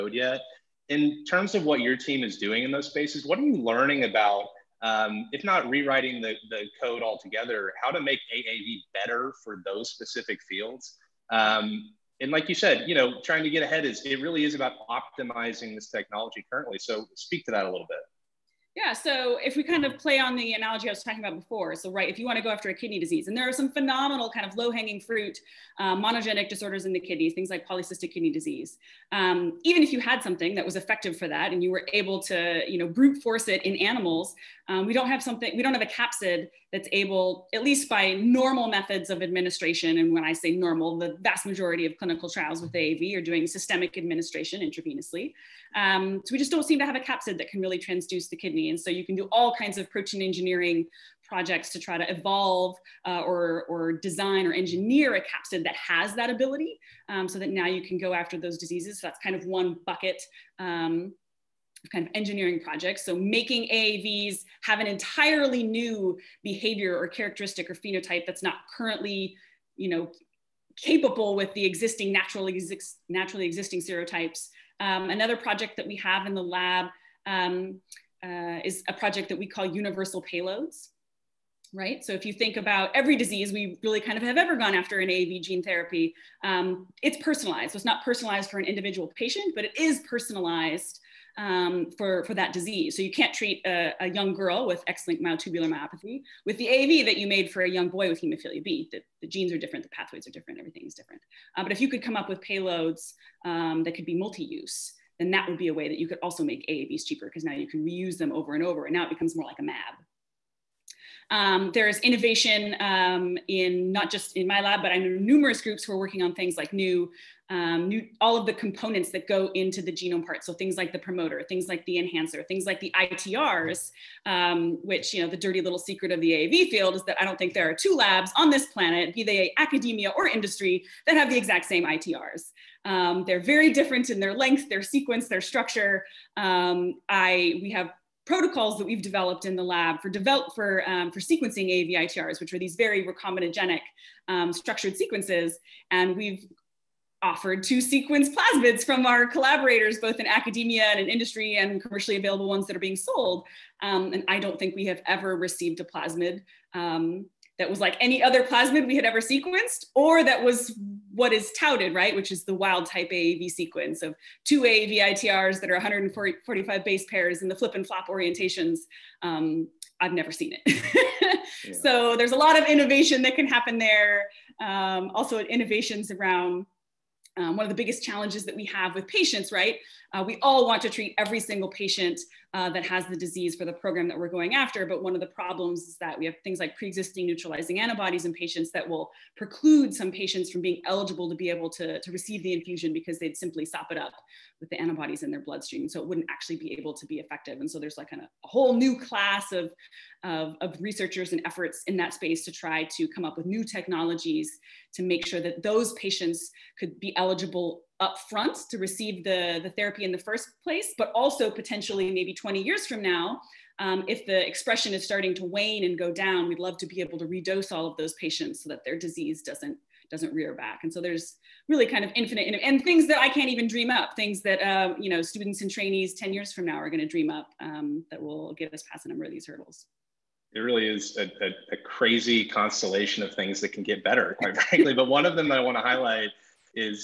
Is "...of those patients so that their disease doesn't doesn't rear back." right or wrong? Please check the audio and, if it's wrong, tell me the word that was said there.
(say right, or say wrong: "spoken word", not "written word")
right.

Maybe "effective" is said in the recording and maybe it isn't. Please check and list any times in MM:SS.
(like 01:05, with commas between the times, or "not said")
00:30, 03:17.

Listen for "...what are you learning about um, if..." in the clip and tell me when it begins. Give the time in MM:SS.
00:03.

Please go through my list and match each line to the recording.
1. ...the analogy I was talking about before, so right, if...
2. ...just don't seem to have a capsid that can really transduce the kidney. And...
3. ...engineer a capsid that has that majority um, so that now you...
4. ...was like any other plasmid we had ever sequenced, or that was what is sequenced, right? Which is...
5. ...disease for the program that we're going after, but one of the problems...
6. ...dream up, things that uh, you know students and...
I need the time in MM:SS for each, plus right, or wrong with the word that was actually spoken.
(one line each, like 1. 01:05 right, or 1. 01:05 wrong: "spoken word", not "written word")
1. 00:20 right
2. 00:46 right
3. 00:54 wrong: "ability", not "majority"
4. 02:37 wrong: "touted", not "sequenced"
5. 03:03 right
6. 03:43 right.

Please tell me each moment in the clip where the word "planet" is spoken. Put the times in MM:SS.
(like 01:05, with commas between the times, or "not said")
02:08.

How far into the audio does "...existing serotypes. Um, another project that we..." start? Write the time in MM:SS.
01:13.